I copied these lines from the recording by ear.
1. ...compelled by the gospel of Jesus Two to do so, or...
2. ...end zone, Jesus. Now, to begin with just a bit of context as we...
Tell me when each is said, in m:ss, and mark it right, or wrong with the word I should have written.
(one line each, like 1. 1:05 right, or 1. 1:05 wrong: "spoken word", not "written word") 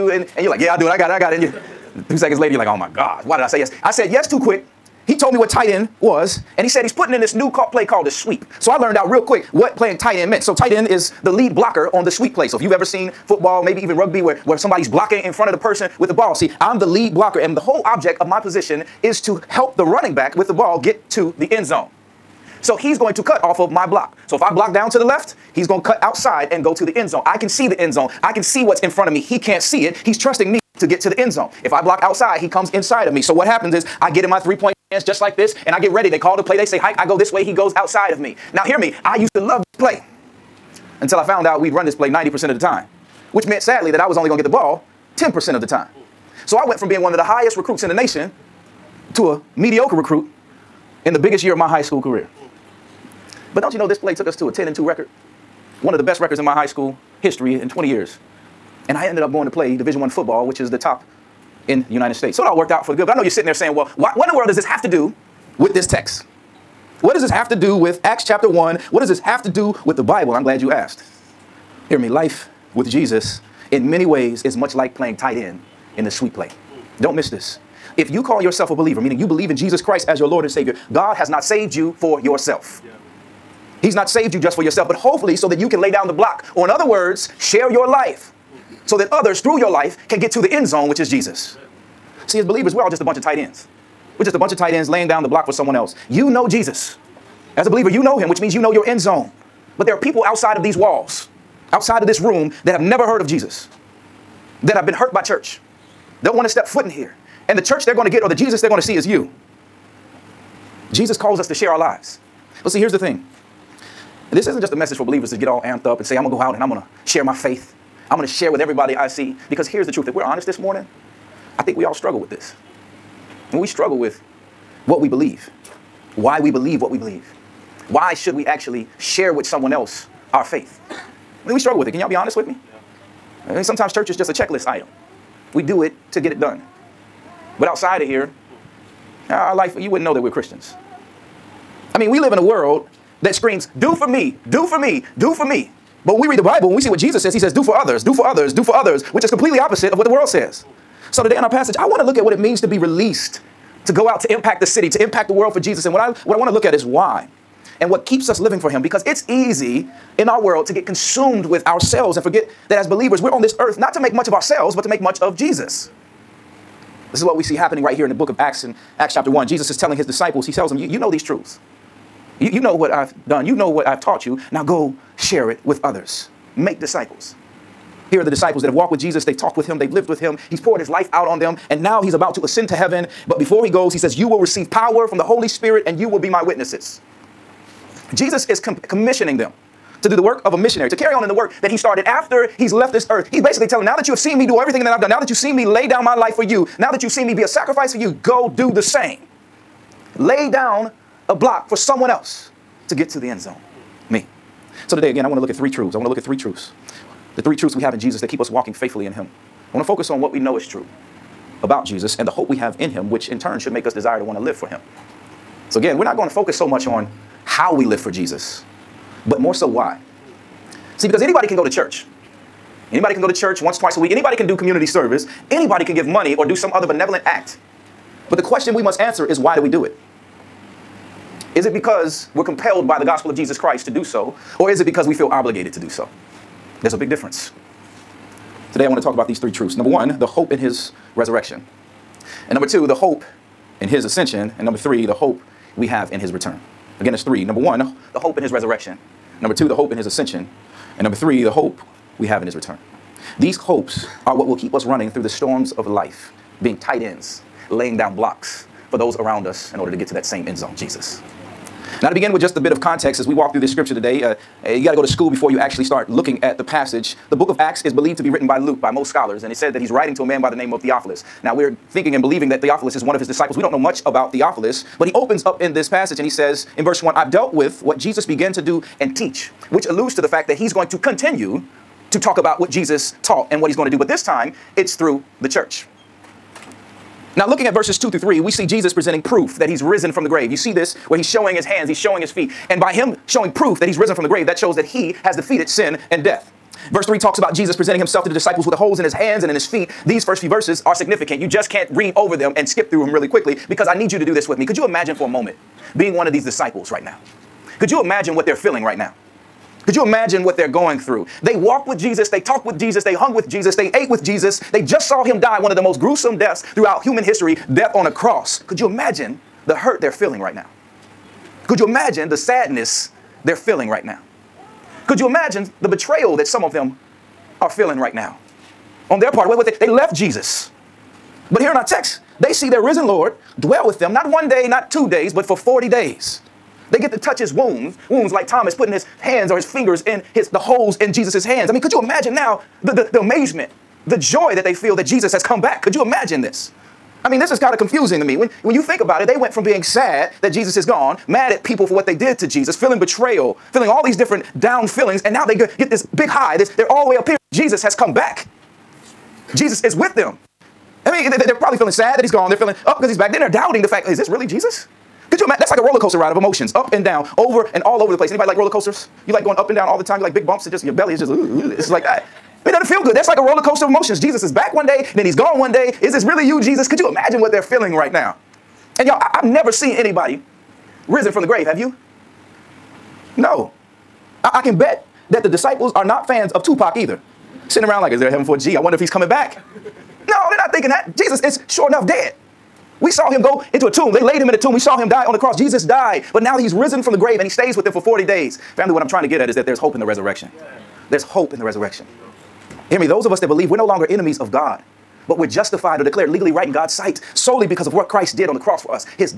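1. 3:52 wrong: "Christ", not "Two"
2. 4:20 right.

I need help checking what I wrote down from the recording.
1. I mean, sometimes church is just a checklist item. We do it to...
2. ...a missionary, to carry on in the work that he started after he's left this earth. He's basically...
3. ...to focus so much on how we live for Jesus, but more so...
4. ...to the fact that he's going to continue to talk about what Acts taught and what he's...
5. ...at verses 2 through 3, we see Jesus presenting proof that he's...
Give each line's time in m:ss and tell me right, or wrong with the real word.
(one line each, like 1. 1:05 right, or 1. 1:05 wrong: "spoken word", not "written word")
1. 2:13 right
2. 3:10 right
3. 3:36 right
4. 4:40 wrong: "Jesus", not "Acts"
5. 4:47 right.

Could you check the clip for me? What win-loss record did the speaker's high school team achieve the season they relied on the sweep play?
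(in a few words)
10 and 2.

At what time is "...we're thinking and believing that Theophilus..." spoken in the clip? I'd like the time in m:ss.
4:31.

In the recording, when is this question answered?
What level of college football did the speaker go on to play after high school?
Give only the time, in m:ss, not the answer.
0:59.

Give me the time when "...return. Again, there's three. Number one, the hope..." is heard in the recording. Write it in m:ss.
4:06.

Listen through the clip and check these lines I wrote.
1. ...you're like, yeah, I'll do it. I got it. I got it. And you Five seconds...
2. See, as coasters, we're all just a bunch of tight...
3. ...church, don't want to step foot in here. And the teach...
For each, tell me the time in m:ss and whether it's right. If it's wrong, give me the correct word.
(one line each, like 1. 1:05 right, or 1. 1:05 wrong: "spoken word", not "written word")
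1. 0:00 wrong: "Two", not "Five"
2. 1:32 wrong: "believers", not "coasters"
3. 1:45 wrong: "church", not "teach".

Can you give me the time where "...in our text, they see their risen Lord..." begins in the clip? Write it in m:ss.
5:31.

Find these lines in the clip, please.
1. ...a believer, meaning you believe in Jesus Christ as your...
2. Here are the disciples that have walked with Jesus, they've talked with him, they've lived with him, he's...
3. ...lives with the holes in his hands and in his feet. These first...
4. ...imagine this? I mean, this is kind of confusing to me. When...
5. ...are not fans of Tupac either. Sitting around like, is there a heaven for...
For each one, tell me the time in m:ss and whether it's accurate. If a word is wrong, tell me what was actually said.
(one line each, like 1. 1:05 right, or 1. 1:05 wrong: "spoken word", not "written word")
1. 1:18 right
2. 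2:58 right
3. 4:58 wrong: "disciples", not "lives"
4. 5:46 right
5. 6:25 right.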